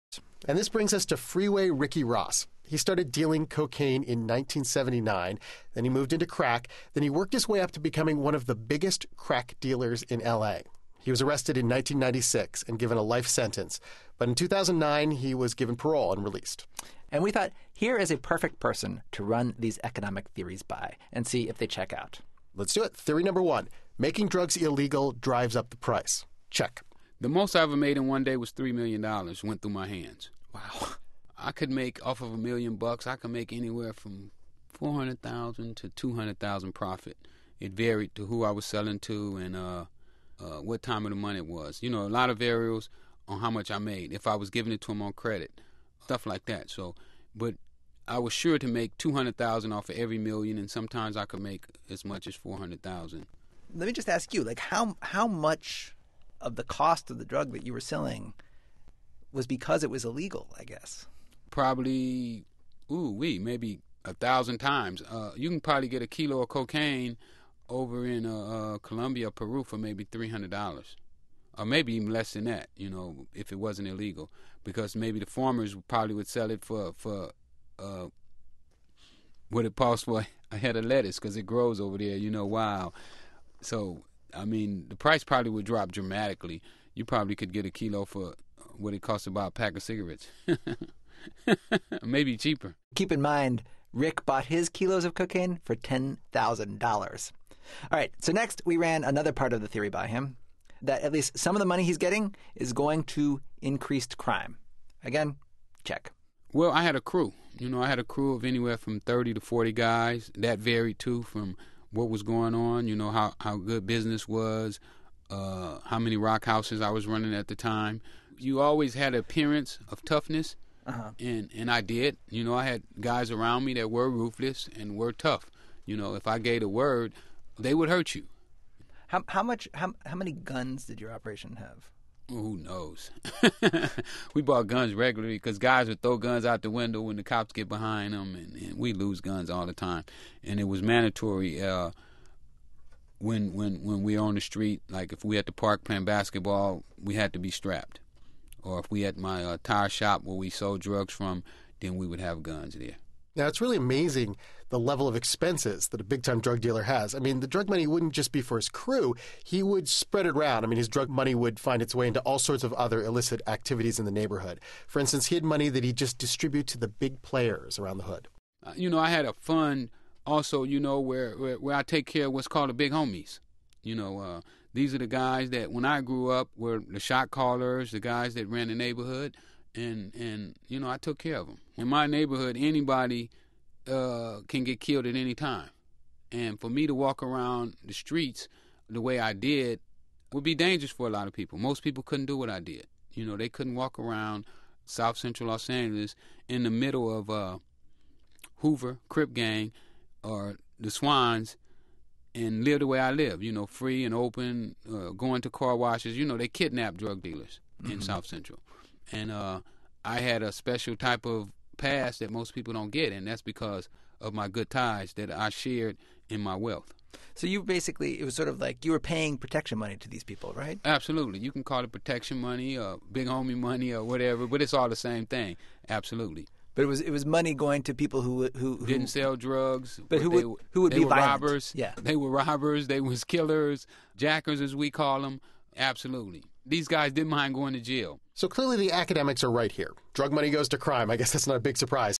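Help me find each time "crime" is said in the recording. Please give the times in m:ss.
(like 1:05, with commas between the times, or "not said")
1:44, 4:00.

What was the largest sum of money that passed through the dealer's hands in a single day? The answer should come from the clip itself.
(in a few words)
$3 million.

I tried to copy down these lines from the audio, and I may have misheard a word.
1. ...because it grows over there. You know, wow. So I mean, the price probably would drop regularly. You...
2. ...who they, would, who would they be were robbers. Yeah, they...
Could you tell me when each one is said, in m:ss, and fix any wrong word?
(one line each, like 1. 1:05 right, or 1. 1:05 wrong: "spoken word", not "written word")
1. 1:21 wrong: "dramatically", not "regularly"
2. 3:50 right.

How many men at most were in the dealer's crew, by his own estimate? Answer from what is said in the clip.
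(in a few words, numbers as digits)
40.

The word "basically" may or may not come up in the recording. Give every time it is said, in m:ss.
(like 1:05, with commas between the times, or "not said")
3:37.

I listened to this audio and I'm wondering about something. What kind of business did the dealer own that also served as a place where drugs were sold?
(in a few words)
tire shop.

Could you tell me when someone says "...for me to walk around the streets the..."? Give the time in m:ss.
3:06.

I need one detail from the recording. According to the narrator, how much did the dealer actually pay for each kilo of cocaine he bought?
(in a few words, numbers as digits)
$10,000.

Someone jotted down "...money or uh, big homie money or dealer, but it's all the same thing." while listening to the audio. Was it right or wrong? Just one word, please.
wrong.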